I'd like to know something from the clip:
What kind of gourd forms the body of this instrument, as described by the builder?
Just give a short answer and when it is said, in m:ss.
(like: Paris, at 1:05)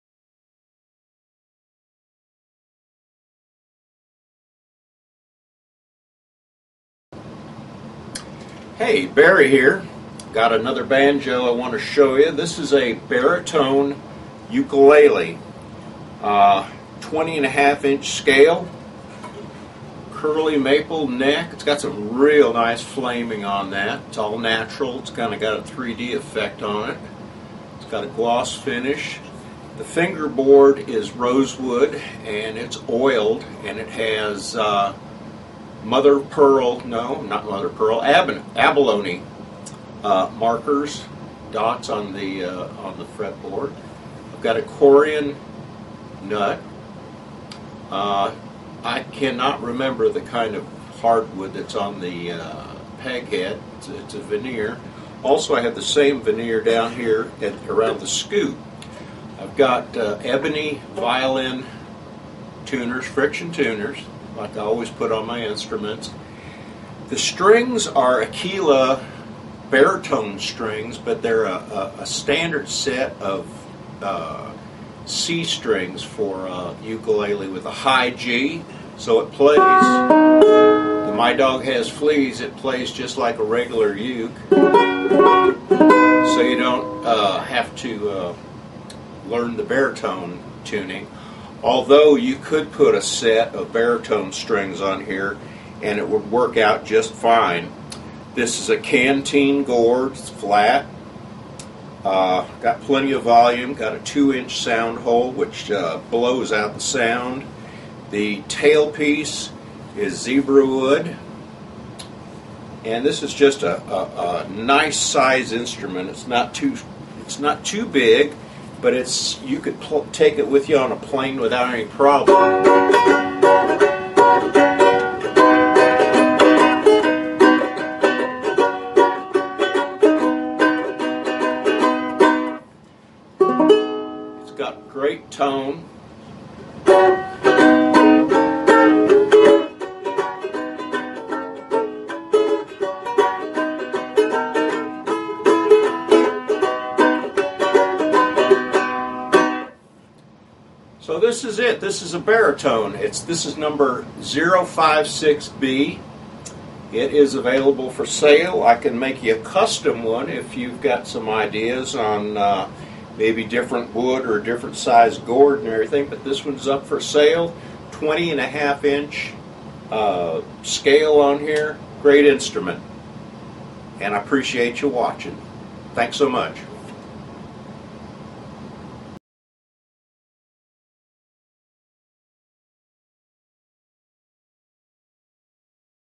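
Canteen gourd, at 1:38.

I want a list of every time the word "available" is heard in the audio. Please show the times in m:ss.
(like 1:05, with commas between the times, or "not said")
2:37.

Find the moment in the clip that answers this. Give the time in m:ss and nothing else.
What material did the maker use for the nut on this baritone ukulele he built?
0:44.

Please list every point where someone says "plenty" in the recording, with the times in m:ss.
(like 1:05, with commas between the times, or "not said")
1:42.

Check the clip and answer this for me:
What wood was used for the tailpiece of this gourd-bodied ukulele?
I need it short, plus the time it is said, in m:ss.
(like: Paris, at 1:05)
Zebra wood, at 1:50.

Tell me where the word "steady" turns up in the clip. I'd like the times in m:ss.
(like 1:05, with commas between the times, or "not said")
not said.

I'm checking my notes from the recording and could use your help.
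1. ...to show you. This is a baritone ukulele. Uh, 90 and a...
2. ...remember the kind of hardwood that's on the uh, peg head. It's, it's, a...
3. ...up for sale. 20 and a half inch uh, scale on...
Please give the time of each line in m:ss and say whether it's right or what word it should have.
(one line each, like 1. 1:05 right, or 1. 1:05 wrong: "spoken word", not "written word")
1. 0:11 wrong: "20", not "90"
2. 0:49 right
3. 2:46 right.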